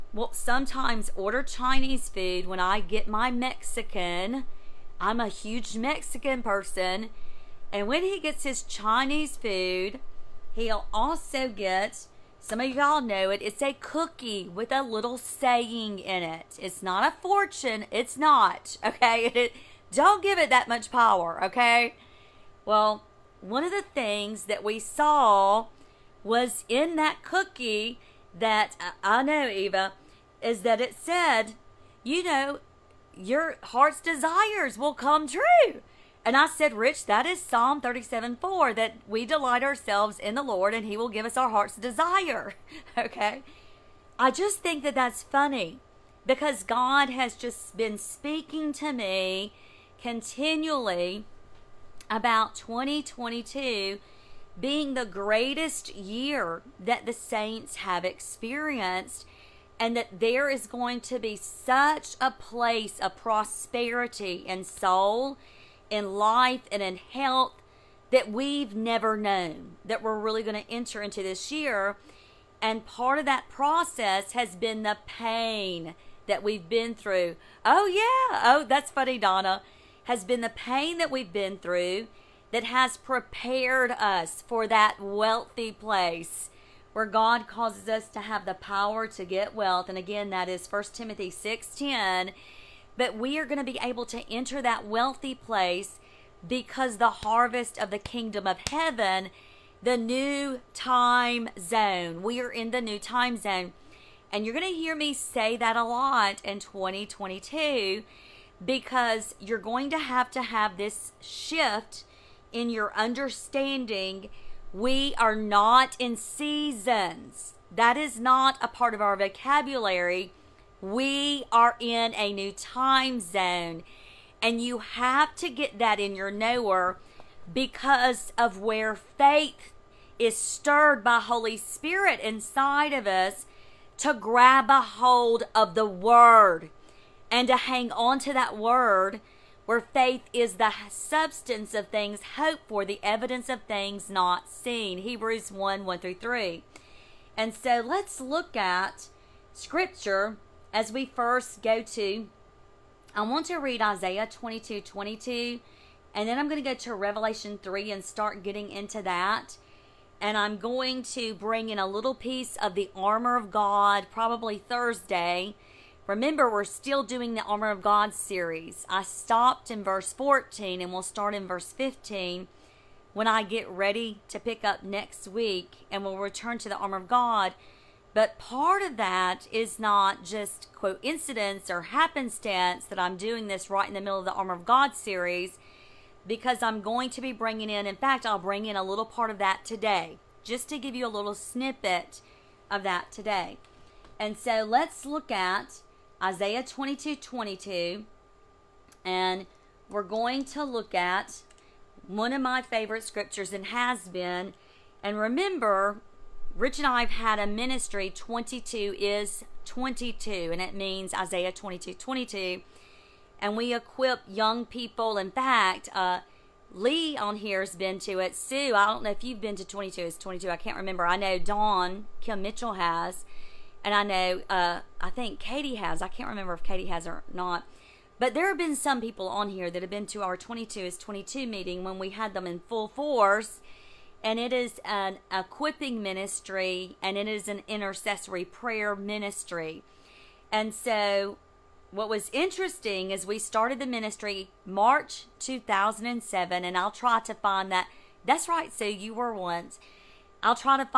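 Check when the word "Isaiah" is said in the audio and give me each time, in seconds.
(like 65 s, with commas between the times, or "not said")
153 s, 196 s, 211 s.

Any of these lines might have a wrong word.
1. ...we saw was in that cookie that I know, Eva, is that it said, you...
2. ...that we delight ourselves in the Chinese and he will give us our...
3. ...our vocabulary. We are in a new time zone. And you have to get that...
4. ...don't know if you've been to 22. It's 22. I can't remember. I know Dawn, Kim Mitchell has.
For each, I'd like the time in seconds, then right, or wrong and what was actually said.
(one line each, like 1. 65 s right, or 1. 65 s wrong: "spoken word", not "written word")
1. 24 s right
2. 38 s wrong: "Lord", not "Chinese"
3. 119 s right
4. 218 s right.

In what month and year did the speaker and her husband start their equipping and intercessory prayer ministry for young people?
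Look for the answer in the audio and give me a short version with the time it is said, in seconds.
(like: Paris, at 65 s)
March 2007, at 244 s.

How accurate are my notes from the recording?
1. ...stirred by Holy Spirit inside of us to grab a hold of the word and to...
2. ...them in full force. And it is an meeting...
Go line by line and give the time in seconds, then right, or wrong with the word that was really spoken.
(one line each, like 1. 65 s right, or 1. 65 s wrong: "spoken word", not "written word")
1. 130 s right
2. 232 s wrong: "equipping", not "meeting".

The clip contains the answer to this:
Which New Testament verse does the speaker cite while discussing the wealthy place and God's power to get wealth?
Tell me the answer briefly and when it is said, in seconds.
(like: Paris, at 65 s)
1 Timothy 6:10, at 90 s.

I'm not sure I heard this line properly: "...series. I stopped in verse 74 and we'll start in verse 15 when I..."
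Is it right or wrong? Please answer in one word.
wrong.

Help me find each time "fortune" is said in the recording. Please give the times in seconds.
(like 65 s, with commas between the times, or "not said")
17 s.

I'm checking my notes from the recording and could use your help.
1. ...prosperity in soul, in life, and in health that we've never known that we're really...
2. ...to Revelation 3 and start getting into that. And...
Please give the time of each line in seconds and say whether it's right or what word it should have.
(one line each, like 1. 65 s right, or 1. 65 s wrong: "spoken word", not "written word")
1. 63 s right
2. 156 s right.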